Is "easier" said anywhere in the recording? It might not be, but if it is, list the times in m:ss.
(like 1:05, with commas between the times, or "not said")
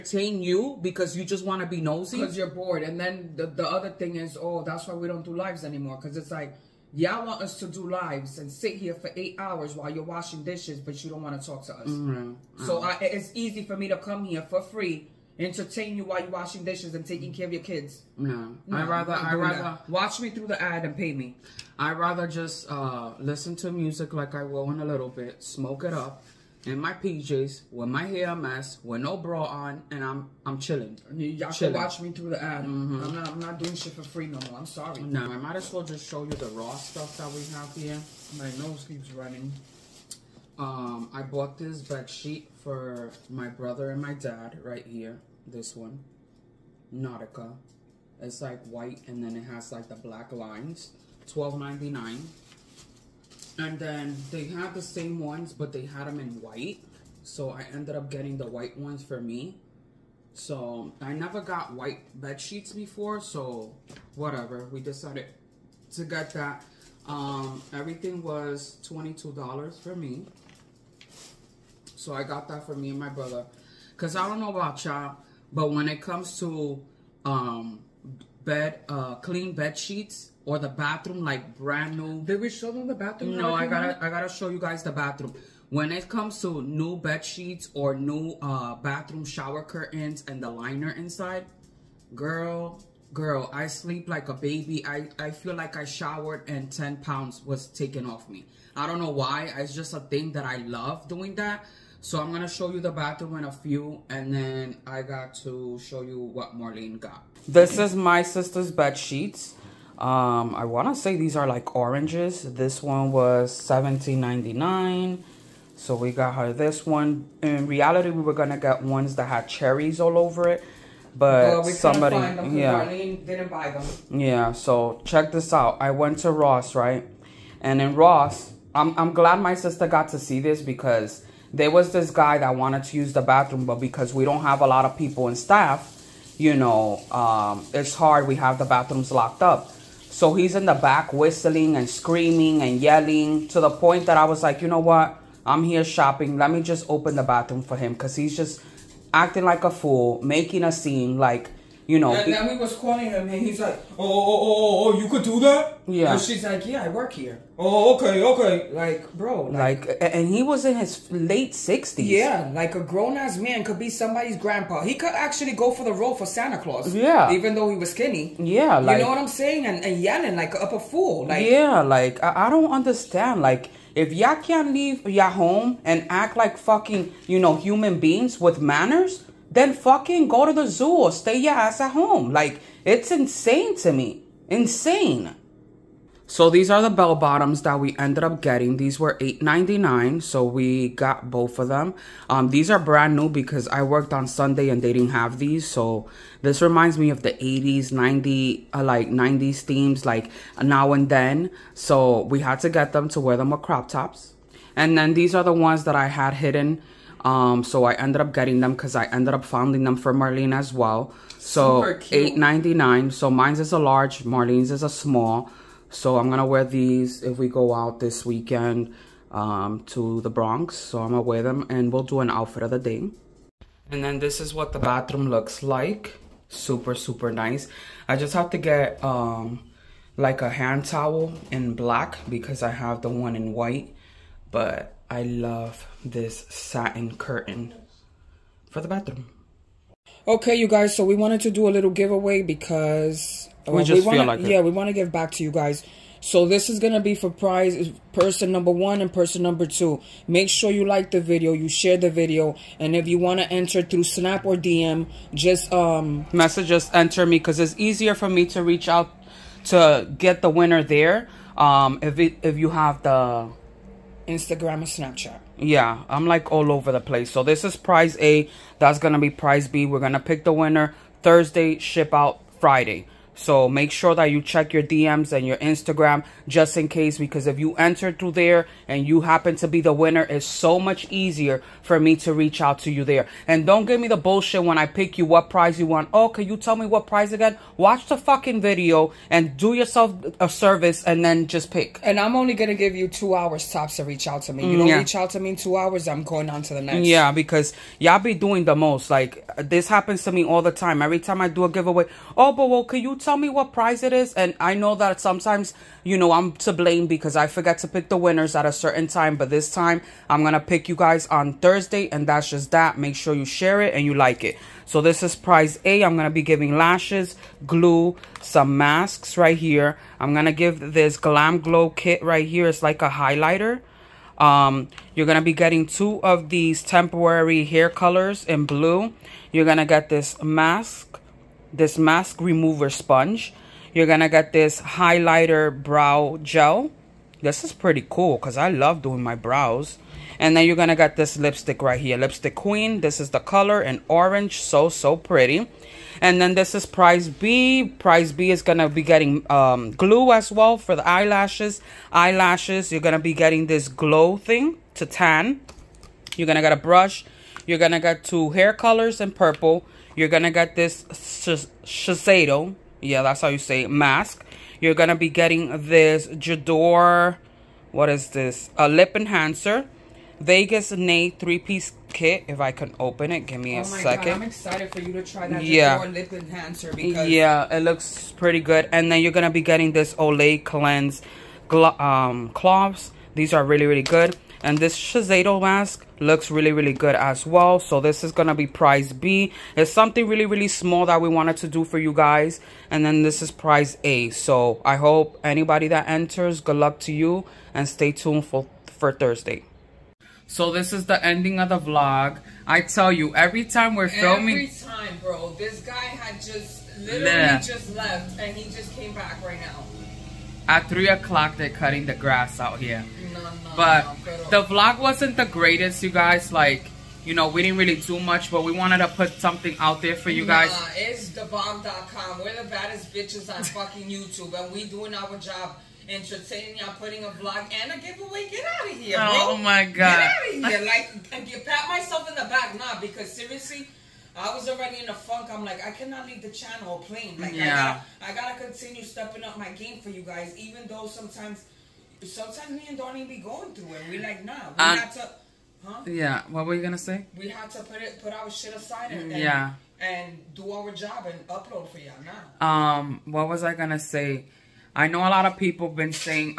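4:17, 4:41.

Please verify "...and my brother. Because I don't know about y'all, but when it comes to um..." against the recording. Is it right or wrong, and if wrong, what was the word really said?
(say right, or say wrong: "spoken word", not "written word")
right.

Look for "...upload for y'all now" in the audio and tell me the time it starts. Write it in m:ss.
7:31.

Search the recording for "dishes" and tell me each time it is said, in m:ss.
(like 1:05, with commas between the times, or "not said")
0:10, 0:16.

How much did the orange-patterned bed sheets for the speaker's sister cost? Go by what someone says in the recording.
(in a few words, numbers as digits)
$17.99.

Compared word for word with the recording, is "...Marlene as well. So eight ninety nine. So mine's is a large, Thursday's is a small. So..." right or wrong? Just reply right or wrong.
wrong.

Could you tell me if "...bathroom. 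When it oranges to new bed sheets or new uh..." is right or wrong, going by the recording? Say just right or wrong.
wrong.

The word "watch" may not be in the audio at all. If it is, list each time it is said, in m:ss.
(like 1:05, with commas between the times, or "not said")
0:19, 0:31, 4:47.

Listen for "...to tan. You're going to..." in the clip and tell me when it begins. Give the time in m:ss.
5:54.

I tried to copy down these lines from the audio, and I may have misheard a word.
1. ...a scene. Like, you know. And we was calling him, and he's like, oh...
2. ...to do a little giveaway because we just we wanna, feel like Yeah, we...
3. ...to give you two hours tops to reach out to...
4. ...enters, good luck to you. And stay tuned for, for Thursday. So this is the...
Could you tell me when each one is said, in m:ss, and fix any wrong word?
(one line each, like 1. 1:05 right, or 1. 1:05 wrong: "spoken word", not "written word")
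1. 2:30 right
2. 4:01 right
3. 4:52 right
4. 6:36 right.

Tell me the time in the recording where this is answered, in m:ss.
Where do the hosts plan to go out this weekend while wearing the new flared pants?
3:40.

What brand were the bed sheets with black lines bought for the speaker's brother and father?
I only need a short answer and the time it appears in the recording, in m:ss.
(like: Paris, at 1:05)
Nautica, at 0:46.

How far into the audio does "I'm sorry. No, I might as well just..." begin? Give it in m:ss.
0:34.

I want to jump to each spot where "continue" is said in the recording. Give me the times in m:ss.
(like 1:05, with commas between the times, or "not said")
7:18.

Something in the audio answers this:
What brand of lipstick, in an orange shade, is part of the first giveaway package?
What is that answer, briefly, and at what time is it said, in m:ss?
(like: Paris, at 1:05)
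Lipstick Queen, at 5:42.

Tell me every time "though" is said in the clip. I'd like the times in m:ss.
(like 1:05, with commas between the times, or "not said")
2:47, 7:20.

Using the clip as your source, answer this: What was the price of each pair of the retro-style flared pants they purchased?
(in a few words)
$8.99.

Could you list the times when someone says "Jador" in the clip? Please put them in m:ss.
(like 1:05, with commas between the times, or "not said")
6:06, 6:15.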